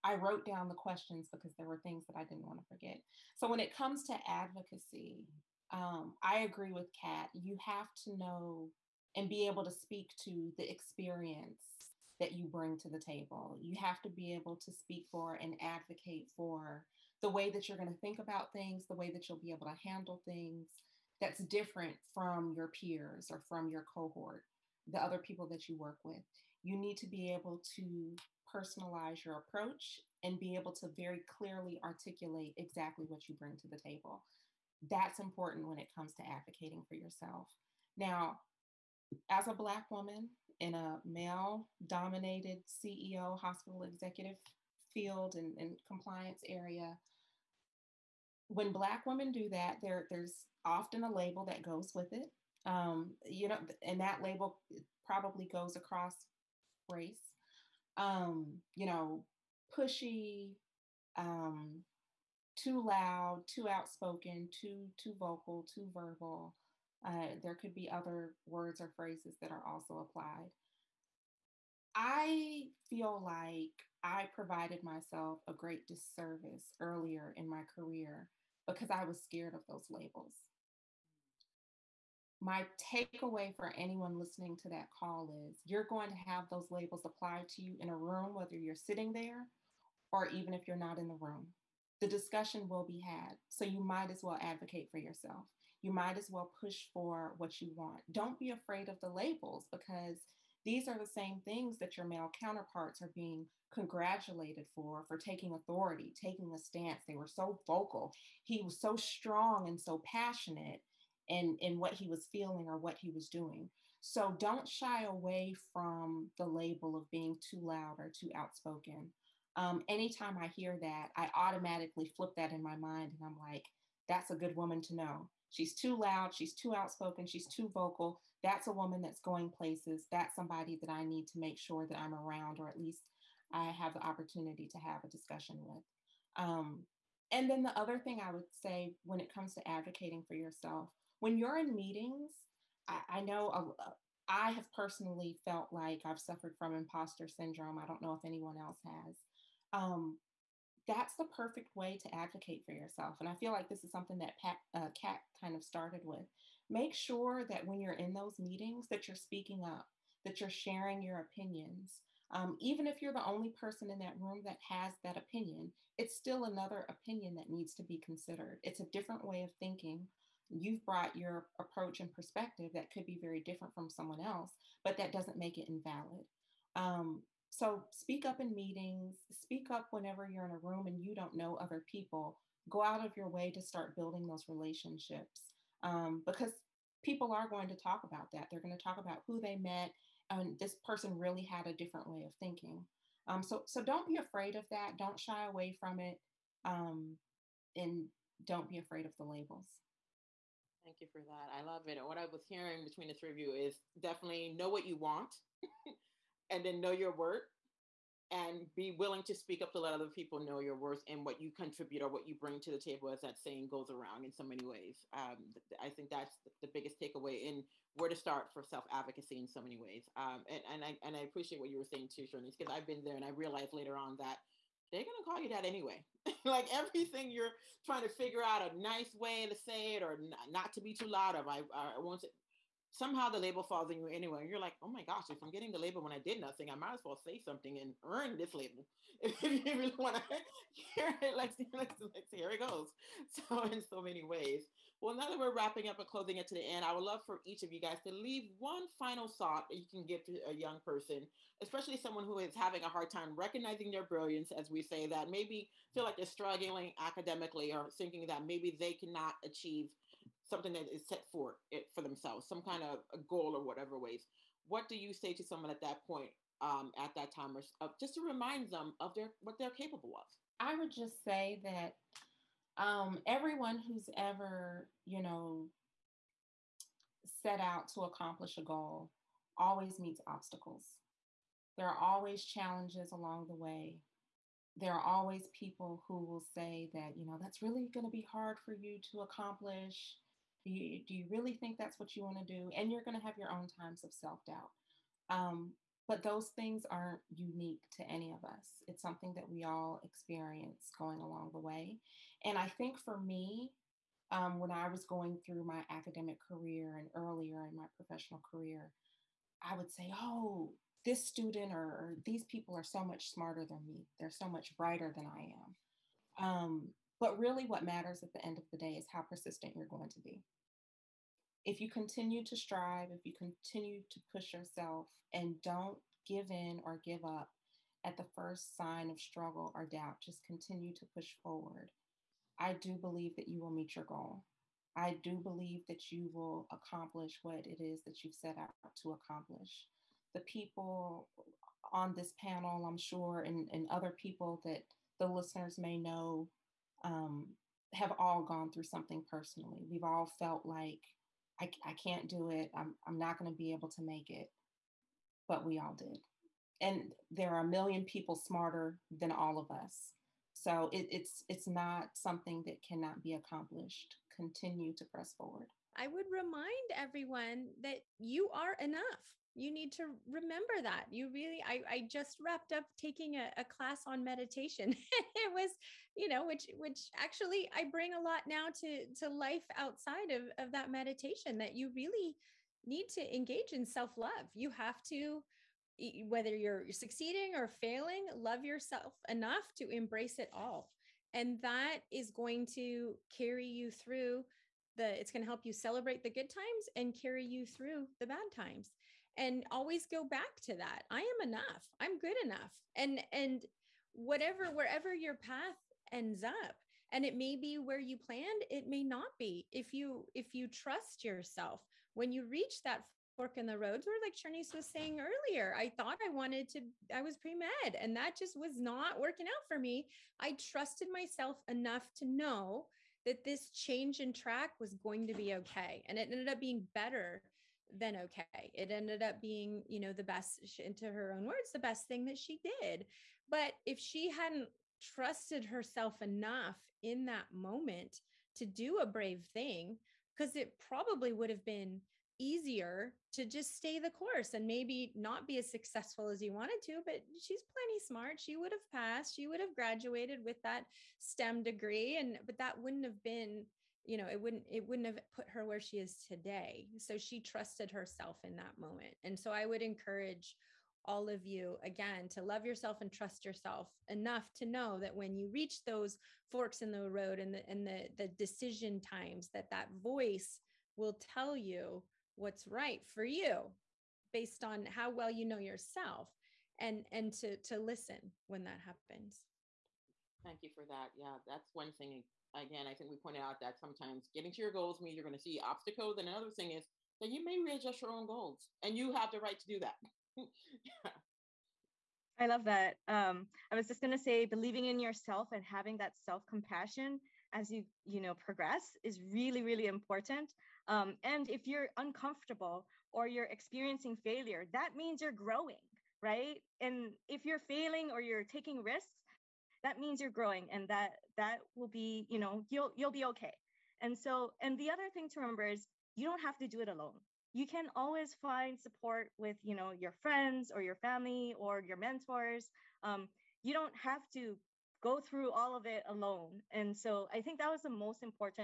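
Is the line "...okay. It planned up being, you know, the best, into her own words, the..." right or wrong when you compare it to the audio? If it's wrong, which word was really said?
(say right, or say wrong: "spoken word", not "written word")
wrong: "ended", not "planned".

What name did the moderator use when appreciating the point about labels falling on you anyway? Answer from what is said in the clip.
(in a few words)
Shirley.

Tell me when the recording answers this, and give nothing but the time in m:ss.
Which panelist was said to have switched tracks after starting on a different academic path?
6:54.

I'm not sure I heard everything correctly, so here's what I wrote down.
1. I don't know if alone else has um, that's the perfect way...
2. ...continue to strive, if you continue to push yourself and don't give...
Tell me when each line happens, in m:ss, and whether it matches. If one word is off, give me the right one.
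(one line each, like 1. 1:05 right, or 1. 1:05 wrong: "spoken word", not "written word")
1. 2:27 wrong: "anyone", not "alone"
2. 5:21 right.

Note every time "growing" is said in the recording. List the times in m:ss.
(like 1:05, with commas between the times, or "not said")
8:25, 8:30.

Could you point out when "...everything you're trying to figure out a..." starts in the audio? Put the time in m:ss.
3:46.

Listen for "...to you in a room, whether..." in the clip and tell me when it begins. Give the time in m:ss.
1:27.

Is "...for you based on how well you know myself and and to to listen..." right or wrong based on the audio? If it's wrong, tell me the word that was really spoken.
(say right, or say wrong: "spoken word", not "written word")
wrong: "yourself", not "myself".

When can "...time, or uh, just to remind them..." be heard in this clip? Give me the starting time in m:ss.
4:27.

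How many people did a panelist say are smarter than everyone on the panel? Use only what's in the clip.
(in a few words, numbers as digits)
A million.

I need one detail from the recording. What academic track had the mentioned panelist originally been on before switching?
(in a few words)
Pre-med.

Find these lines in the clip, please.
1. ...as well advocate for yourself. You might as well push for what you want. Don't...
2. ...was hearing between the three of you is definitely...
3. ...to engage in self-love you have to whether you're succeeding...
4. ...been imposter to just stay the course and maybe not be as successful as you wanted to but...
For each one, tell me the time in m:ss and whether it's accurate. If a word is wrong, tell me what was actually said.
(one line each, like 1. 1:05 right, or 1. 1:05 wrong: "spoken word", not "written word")
1. 1:34 right
2. 3:22 right
3. 6:23 right
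4. 7:21 wrong: "easier", not "imposter".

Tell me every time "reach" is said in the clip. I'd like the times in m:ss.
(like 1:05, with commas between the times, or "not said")
6:52, 7:45.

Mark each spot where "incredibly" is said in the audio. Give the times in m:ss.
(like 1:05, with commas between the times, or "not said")
not said.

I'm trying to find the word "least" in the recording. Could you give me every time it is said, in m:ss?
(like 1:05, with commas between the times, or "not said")
2:12.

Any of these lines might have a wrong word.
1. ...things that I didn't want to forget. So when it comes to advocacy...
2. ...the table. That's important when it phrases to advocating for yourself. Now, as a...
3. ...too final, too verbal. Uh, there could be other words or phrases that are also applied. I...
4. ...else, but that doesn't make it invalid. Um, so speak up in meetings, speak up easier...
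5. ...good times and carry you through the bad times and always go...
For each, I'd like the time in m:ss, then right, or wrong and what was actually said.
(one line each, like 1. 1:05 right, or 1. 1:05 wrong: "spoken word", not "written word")
1. 0:01 right
2. 0:33 wrong: "comes", not "phrases"
3. 1:04 wrong: "vocal", not "final"
4. 2:54 wrong: "whenever", not "easier"
5. 6:36 right.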